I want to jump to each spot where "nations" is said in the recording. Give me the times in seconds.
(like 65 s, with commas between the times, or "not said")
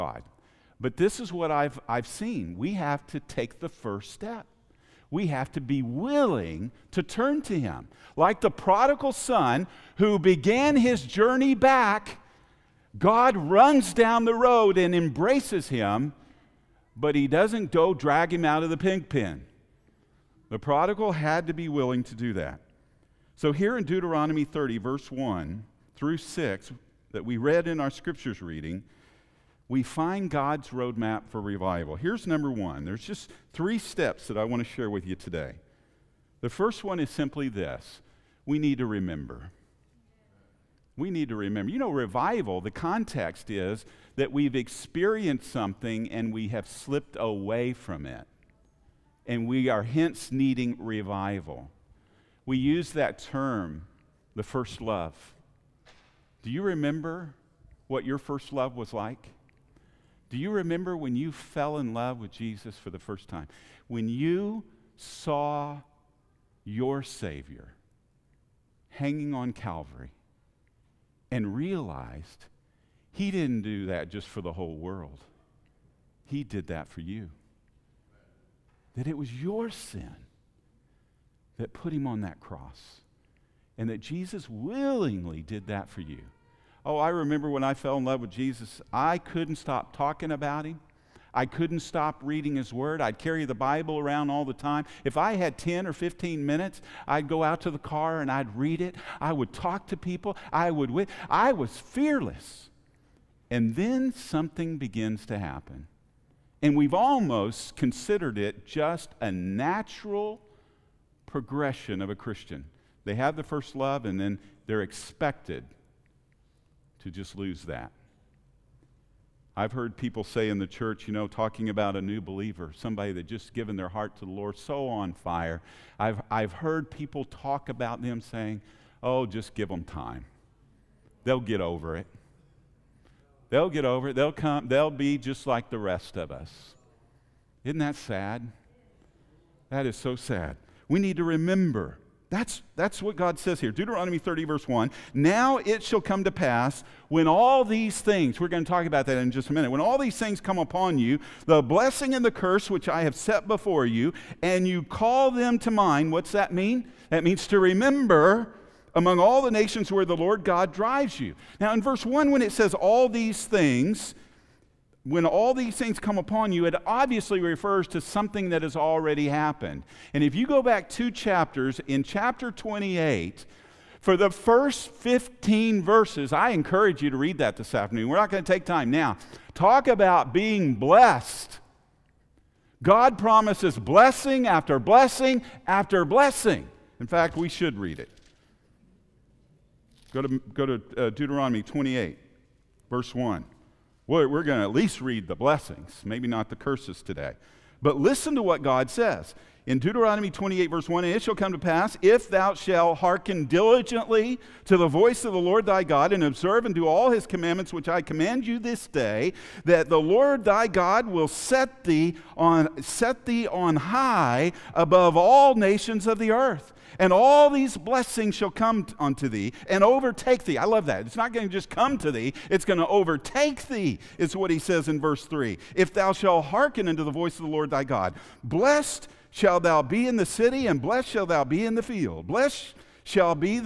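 159 s, 215 s.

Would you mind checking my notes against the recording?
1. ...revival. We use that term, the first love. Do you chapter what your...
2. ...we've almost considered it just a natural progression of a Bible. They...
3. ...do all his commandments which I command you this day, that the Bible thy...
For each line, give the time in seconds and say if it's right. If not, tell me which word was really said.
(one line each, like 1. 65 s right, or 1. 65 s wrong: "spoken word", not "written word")
1. 50 s wrong: "remember", not "chapter"
2. 106 s wrong: "Christian", not "Bible"
3. 206 s wrong: "Lord", not "Bible".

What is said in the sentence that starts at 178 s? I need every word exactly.
We're not going to take time now.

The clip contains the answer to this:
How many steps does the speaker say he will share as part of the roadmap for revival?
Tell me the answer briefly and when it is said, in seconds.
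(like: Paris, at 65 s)
3, at 33 s.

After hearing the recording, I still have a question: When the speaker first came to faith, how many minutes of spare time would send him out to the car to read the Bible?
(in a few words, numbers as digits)
10 or 15.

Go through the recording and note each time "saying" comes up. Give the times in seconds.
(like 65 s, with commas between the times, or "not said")
128 s.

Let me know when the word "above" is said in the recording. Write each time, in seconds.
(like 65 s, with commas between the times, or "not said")
214 s.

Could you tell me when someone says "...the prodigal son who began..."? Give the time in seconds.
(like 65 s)
8 s.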